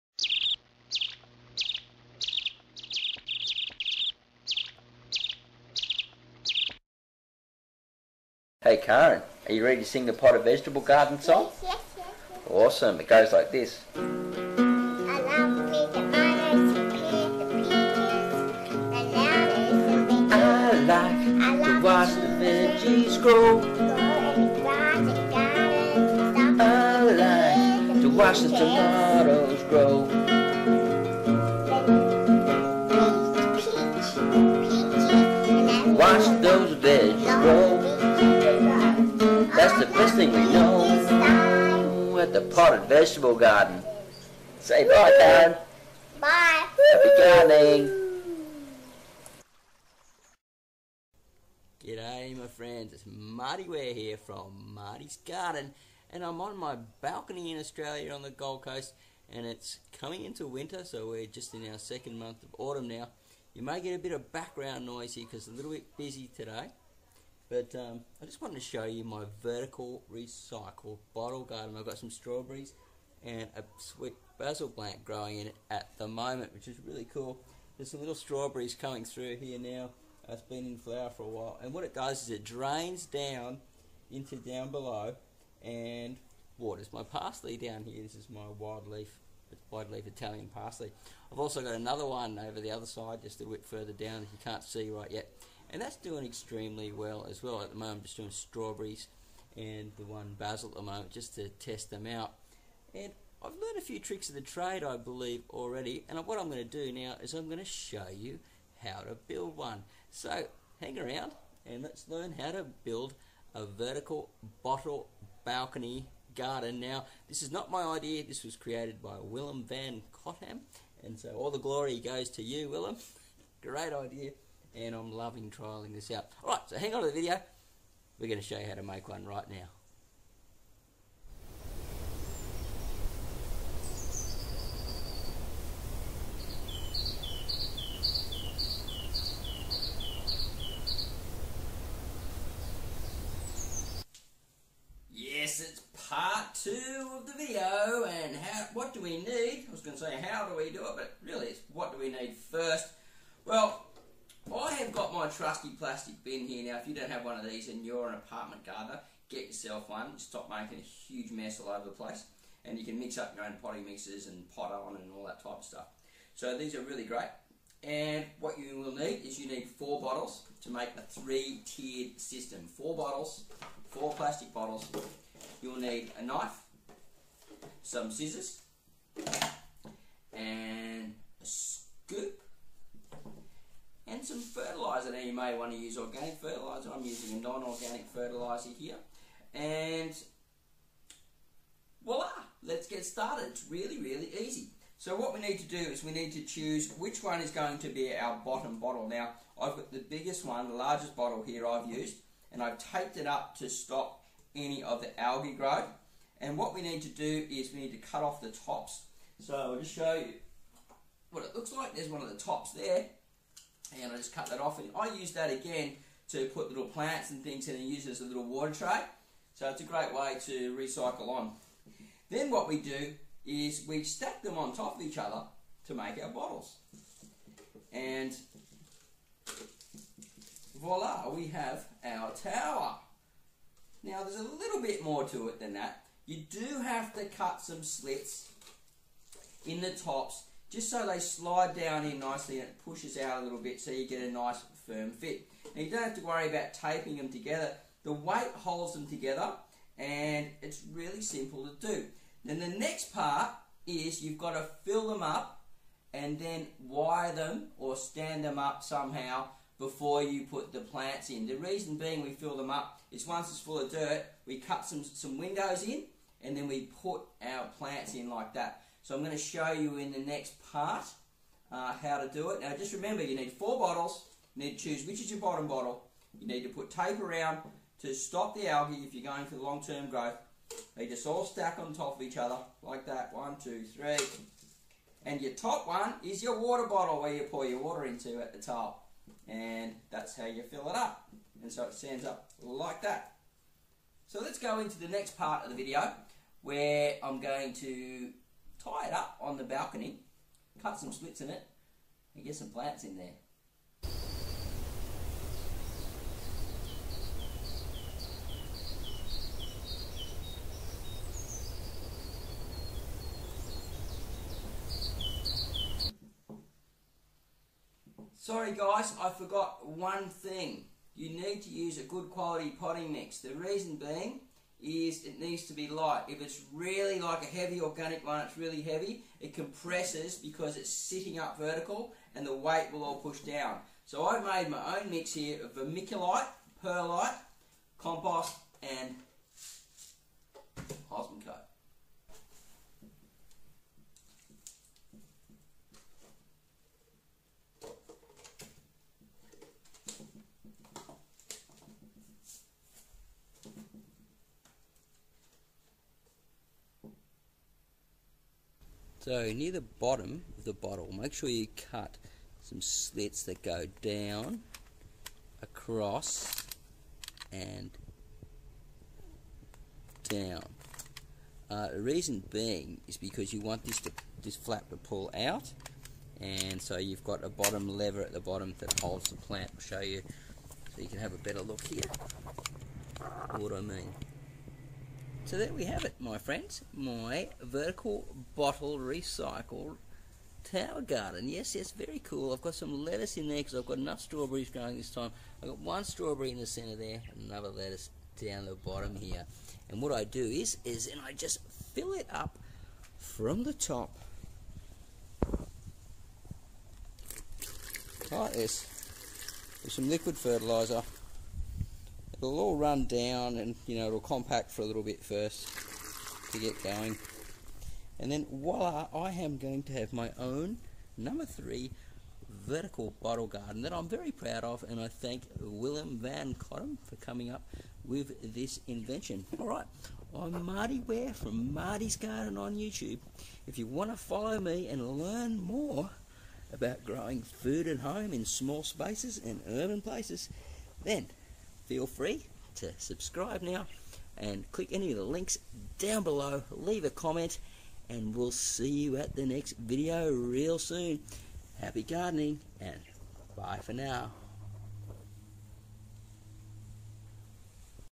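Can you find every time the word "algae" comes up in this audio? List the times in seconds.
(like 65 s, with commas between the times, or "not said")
205 s, 278 s.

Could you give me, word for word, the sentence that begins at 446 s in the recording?
Leave a comment and we'll see you at the next video real soon.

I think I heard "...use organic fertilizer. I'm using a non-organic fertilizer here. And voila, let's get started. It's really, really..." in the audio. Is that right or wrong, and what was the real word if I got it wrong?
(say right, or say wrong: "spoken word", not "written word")
right.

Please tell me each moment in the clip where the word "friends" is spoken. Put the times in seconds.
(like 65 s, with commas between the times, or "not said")
52 s, 386 s.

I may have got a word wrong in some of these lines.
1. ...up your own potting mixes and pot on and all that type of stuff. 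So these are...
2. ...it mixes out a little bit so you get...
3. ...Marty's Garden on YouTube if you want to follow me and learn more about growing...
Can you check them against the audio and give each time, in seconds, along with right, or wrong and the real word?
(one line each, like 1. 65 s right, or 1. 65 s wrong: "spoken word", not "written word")
1. 163 s right
2. 242 s wrong: "pushes", not "mixes"
3. 431 s right.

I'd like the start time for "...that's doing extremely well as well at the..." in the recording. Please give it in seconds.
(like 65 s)
95 s.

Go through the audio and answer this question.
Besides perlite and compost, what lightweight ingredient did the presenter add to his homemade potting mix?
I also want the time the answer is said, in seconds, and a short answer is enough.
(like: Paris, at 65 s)
Vermiculite, at 335 s.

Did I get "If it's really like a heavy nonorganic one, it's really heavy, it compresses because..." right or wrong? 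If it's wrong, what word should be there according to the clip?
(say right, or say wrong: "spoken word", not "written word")
wrong: "organic", not "nonorganic".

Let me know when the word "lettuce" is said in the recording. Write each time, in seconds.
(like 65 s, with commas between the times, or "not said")
393 s, 397 s.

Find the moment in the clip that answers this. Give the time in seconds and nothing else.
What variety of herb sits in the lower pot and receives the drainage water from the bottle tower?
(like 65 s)
90 s.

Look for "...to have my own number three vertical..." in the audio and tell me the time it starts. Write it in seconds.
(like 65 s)
419 s.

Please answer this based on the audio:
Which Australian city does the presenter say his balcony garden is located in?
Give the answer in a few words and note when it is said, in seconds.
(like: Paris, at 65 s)
Gold Coast, at 58 s.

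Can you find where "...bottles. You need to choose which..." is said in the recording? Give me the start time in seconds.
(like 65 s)
273 s.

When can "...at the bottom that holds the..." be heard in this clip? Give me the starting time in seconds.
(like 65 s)
378 s.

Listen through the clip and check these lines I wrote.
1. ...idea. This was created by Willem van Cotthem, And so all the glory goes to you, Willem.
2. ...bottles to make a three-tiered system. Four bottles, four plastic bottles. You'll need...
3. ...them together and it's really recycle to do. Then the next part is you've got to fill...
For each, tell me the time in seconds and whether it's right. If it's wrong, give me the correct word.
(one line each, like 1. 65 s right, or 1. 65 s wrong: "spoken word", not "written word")
1. 117 s right
2. 170 s right
3. 248 s wrong: "simple", not "recycle".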